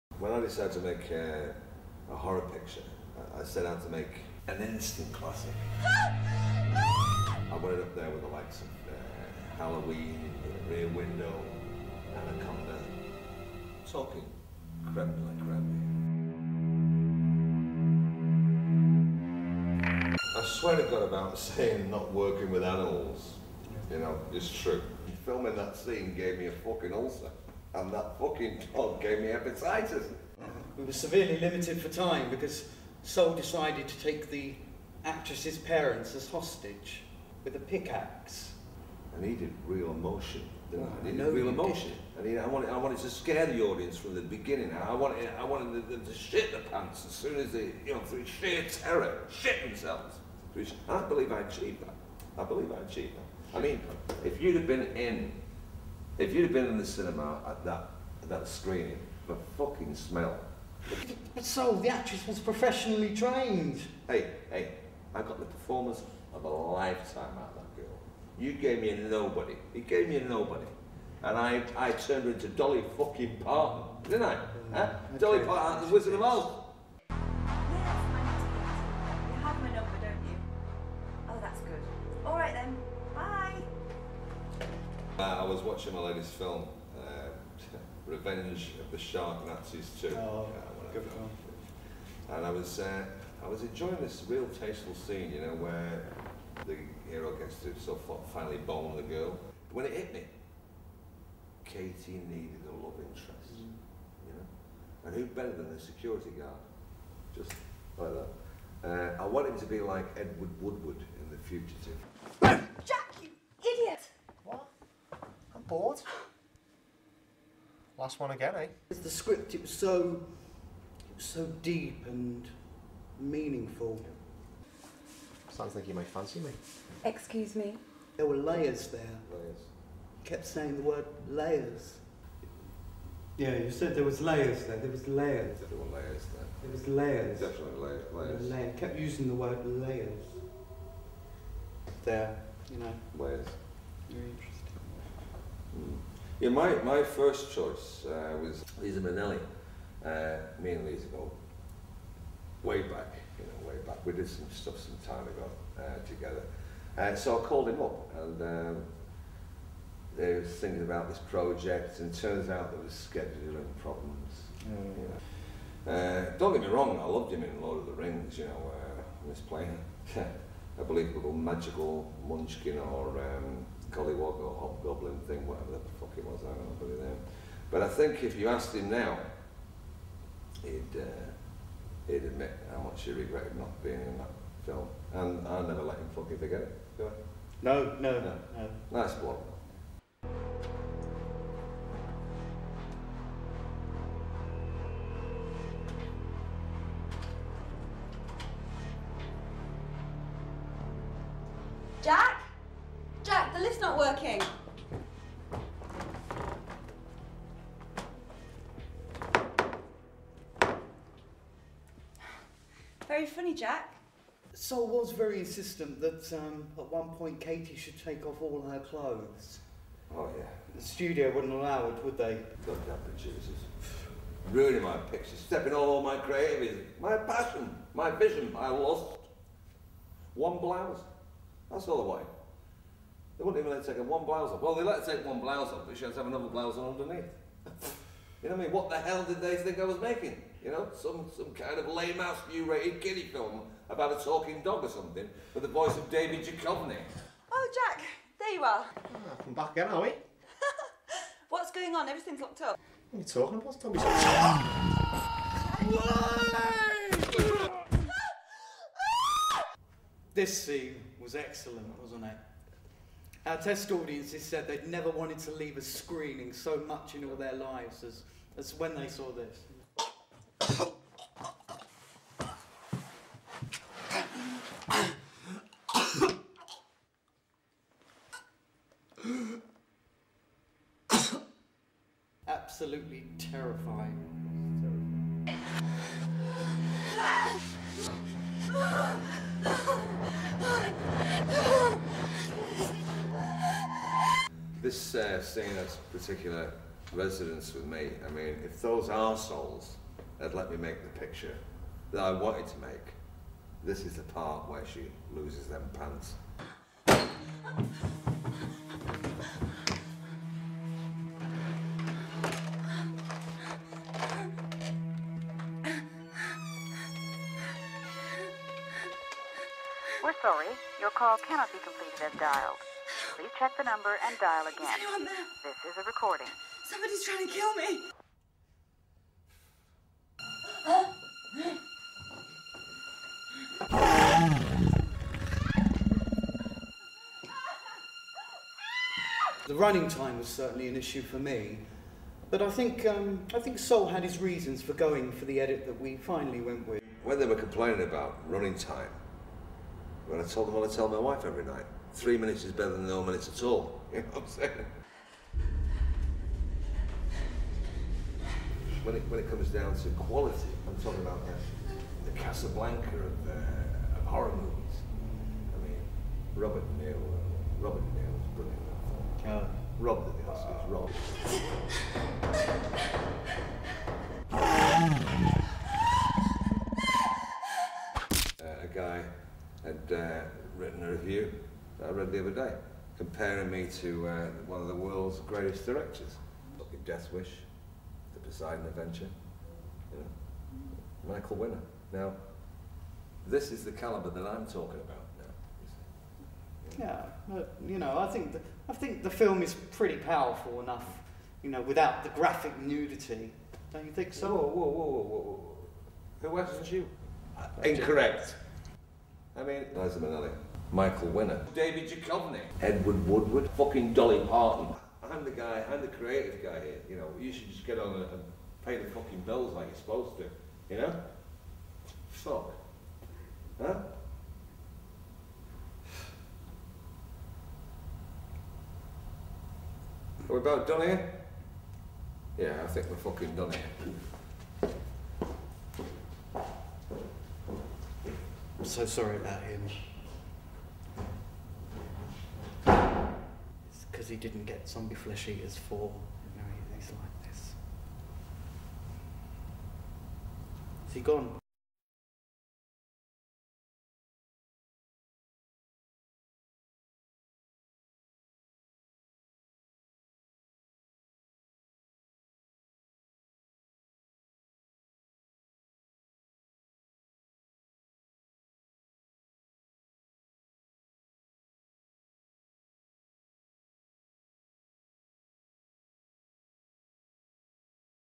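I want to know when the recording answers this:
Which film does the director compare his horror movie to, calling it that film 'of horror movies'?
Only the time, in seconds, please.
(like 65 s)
362 s.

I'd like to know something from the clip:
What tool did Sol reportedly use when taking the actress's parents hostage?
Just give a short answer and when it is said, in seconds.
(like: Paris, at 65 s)
pickaxe, at 37 s.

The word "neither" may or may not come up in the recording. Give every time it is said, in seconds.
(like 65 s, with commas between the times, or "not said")
not said.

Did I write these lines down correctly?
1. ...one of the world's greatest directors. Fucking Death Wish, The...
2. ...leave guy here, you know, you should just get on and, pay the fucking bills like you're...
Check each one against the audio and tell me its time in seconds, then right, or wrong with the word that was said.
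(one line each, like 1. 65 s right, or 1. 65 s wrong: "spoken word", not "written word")
1. 384 s right
2. 416 s wrong: "creative", not "leave".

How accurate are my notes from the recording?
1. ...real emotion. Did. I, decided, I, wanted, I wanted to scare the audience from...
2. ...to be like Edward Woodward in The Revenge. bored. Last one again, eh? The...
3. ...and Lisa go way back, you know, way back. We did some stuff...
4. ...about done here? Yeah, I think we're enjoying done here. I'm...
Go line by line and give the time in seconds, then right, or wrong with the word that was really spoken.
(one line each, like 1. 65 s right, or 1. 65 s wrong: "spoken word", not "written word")
1. 41 s wrong: "needed", not "decided"
2. 109 s wrong: "Fugitive", not "Revenge"
3. 150 s right
4. 430 s wrong: "fucking", not "enjoying".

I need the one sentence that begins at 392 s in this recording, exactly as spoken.
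Now, this is the caliber that I'm talking about now.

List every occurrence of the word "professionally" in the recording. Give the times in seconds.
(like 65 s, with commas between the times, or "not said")
62 s.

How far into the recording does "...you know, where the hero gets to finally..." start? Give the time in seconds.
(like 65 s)
95 s.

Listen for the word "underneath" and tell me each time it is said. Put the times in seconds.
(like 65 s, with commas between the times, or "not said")
236 s.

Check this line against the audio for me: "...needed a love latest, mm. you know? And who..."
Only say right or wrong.
wrong.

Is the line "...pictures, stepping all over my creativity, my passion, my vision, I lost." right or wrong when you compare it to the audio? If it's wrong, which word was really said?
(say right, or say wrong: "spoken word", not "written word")
right.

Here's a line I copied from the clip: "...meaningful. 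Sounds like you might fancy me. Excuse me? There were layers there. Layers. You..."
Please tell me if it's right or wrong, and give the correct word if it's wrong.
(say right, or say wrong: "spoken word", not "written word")
right.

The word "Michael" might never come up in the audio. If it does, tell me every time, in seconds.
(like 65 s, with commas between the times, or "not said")
391 s, 410 s.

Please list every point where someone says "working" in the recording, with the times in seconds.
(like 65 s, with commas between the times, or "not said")
22 s, 203 s.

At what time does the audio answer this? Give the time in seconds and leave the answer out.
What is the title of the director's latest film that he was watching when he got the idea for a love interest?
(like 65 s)
88 s.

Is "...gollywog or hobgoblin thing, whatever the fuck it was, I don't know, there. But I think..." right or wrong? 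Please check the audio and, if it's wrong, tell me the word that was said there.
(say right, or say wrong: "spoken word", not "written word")
right.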